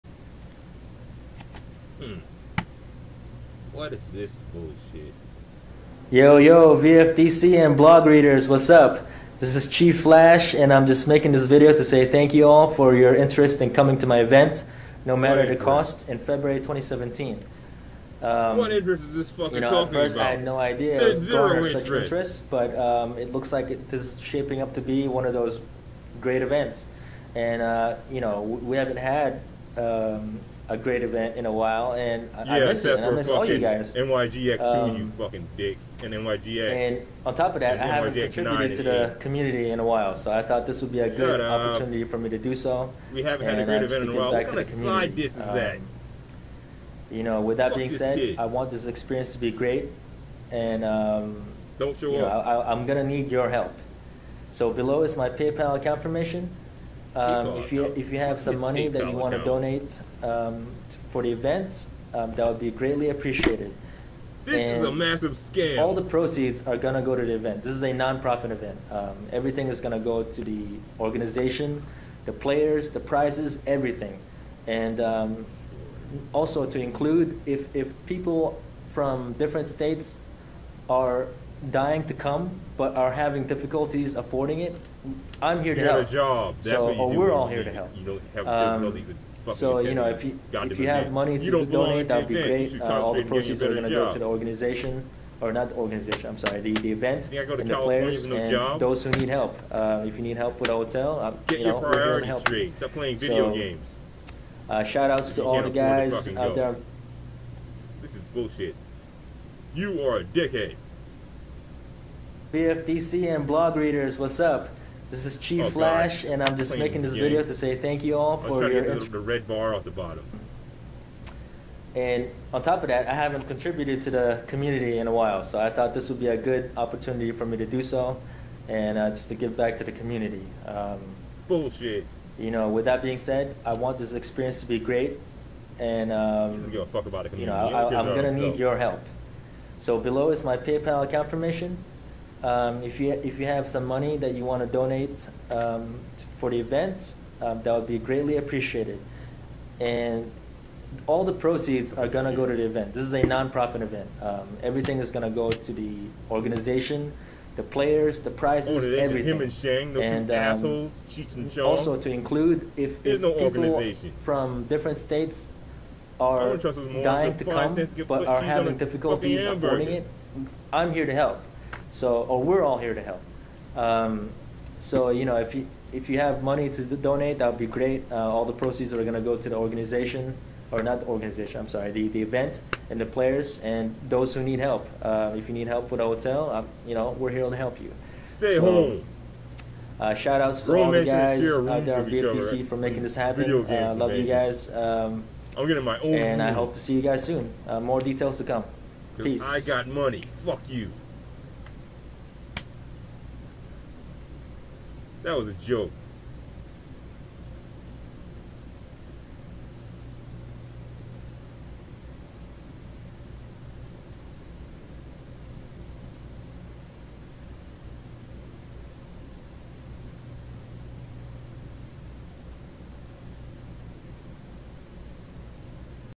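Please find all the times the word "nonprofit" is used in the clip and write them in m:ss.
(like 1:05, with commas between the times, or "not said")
2:33.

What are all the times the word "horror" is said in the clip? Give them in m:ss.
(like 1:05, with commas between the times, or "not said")
not said.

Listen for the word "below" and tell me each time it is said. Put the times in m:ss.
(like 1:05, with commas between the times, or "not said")
0:54, 2:19.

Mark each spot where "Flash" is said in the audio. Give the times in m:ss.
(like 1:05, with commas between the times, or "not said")
0:10, 1:55.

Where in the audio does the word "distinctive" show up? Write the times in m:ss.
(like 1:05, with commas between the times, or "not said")
not said.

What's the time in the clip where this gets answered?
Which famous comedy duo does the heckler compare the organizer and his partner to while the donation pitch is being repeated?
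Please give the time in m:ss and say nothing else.
2:41.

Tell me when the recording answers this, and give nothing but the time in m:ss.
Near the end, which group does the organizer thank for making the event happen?
3:12.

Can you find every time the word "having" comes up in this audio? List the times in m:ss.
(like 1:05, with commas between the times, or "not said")
1:23, 2:48.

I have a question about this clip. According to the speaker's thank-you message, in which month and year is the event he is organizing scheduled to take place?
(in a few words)
February 2017.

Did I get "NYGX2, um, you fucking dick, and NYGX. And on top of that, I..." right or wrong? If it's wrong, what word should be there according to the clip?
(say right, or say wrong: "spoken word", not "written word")
right.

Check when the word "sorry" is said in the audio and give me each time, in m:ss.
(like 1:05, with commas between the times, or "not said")
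1:36, 3:01.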